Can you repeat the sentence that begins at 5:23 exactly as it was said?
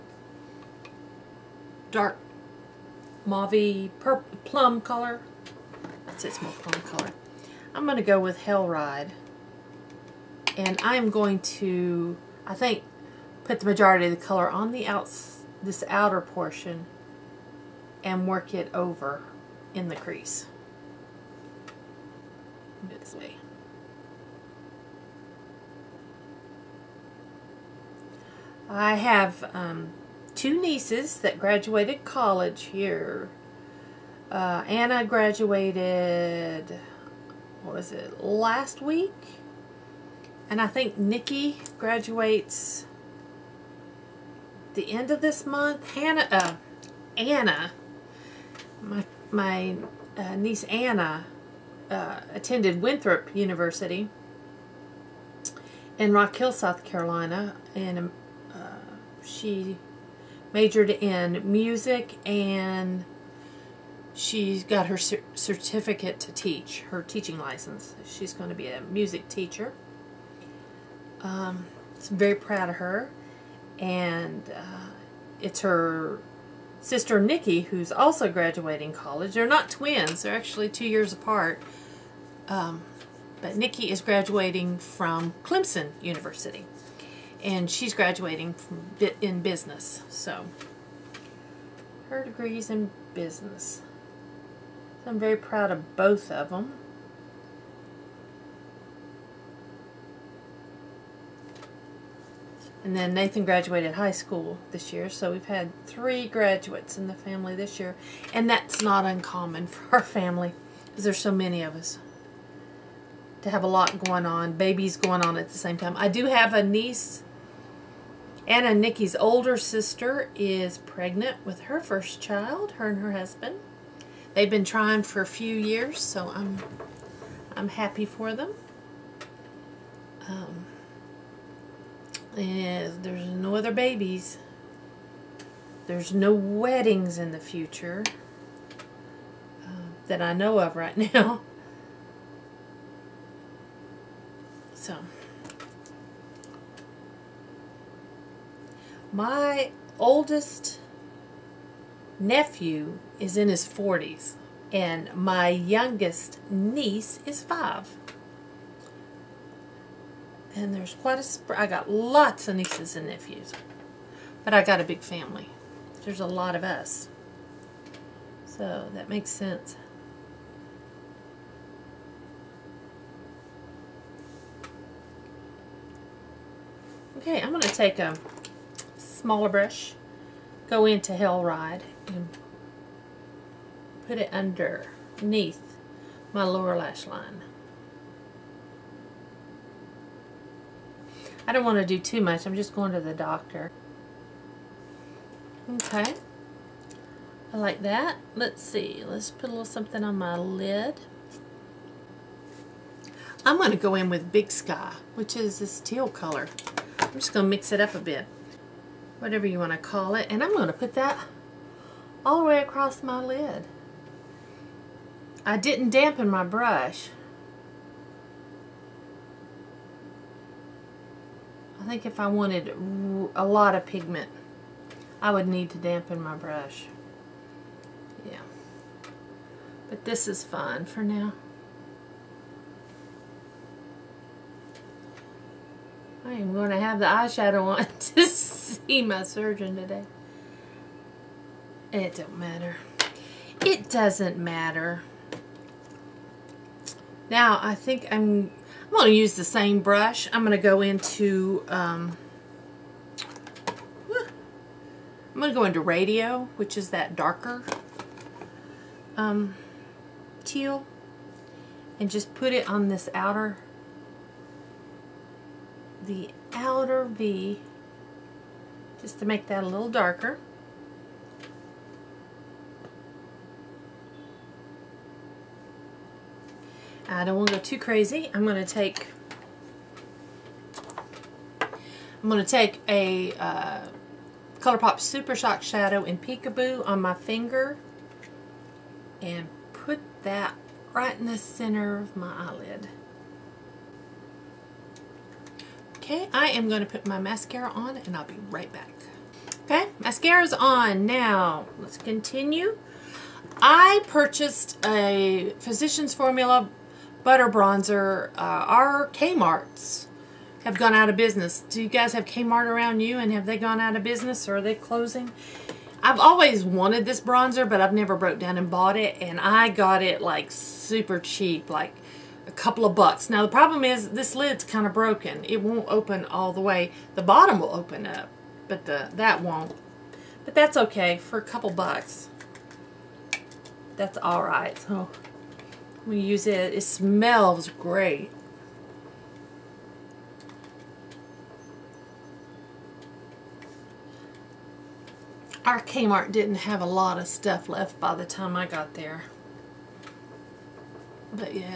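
Now the problem is this lid's kind of broken.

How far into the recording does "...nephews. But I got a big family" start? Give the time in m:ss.
2:43.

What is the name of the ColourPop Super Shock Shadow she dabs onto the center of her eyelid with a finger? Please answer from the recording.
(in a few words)
Peekaboo.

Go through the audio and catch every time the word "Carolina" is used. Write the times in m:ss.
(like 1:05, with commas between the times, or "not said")
0:56.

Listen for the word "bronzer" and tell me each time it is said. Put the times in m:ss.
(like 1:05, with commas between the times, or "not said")
5:07, 5:17.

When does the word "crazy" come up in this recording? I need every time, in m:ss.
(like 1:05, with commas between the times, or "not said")
4:37.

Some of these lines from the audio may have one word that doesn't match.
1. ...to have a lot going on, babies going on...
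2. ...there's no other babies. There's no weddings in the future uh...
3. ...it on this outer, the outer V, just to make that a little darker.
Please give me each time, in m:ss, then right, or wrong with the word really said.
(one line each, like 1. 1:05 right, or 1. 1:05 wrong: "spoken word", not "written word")
1. 1:53 right
2. 2:12 right
3. 4:22 right.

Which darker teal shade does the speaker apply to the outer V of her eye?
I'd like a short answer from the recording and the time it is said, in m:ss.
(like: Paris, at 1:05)
Radio, at 4:15.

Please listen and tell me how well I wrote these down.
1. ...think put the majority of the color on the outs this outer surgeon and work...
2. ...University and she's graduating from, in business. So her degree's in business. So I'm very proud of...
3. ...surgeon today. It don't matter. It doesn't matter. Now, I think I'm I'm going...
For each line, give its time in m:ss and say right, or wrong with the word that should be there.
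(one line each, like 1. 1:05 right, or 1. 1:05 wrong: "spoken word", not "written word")
1. 0:12 wrong: "portion", not "surgeon"
2. 1:25 right
3. 3:59 right.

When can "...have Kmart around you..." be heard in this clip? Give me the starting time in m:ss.
5:12.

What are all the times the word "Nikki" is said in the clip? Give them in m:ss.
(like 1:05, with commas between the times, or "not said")
0:40, 1:17, 1:23, 1:58.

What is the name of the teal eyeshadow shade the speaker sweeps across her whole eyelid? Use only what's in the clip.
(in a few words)
Big Sky.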